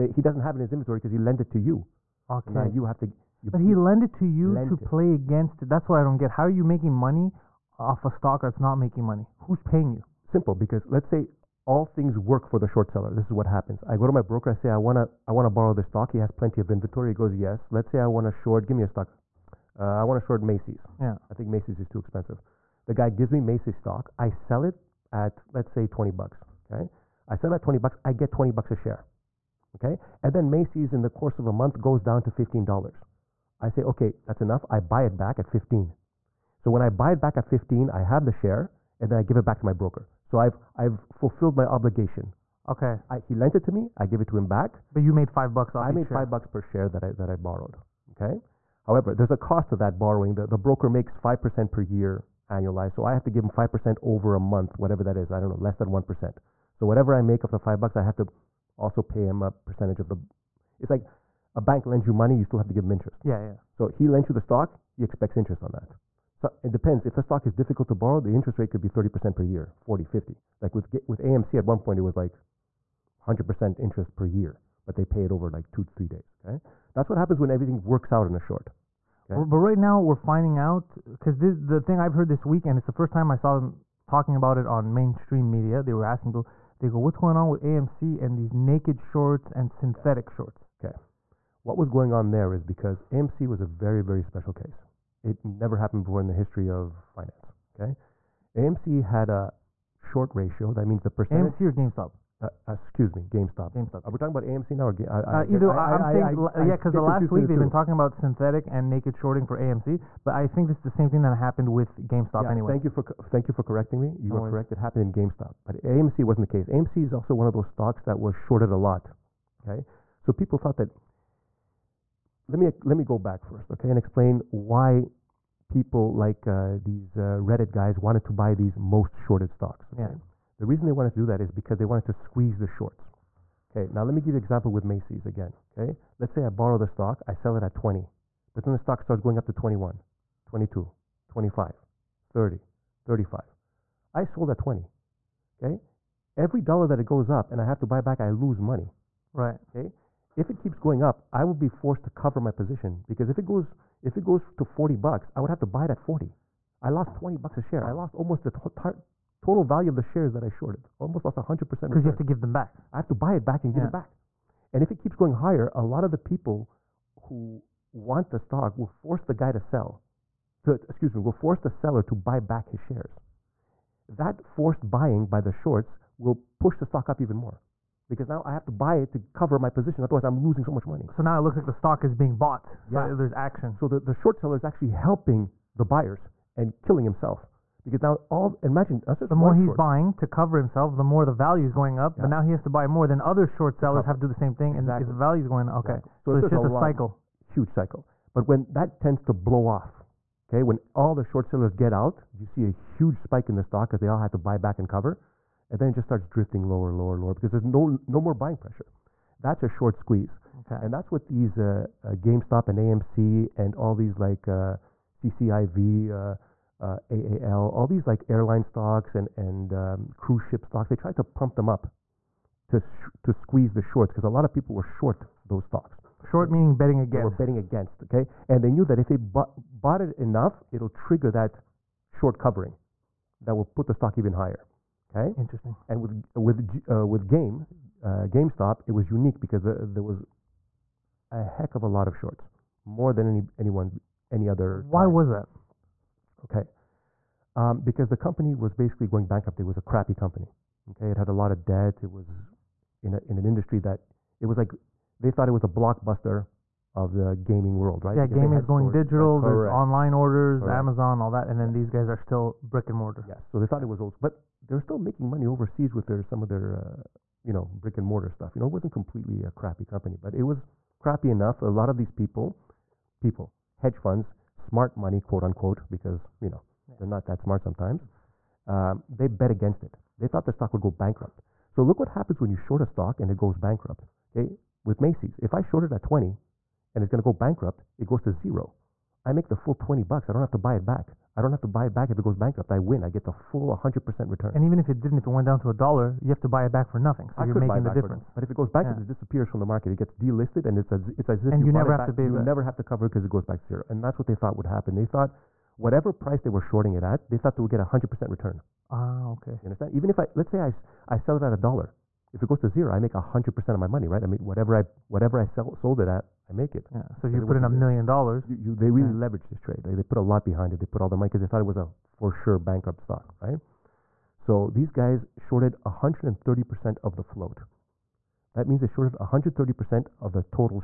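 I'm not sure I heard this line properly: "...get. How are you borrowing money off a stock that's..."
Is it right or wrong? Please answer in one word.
wrong.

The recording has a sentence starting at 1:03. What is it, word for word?
So he lends you the stock, he expects interest on that.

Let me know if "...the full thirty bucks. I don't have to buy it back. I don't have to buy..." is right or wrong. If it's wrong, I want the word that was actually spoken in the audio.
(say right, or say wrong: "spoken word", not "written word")
wrong: "twenty", not "thirty".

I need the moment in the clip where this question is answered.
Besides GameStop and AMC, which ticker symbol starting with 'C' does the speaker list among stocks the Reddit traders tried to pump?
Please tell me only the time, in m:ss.
3:35.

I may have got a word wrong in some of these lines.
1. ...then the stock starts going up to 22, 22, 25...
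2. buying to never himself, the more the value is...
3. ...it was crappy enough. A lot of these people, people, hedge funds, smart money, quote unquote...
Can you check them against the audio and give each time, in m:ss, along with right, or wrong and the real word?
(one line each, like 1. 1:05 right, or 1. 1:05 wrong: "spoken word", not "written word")
1. 2:18 wrong: "21", not "22"
2. 3:09 wrong: "cover", not "never"
3. 4:30 right.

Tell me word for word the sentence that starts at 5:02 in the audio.
never have to cover because it, goes back to zero.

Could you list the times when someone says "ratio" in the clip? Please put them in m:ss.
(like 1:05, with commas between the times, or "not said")
1:40.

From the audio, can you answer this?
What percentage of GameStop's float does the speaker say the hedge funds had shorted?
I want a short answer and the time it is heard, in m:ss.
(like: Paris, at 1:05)
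130%, at 5:25.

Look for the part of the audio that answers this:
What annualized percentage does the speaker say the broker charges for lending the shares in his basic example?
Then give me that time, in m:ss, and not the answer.
0:51.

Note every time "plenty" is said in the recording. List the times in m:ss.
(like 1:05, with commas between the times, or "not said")
0:16.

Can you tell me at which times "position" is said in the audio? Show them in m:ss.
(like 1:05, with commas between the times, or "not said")
2:32, 2:59.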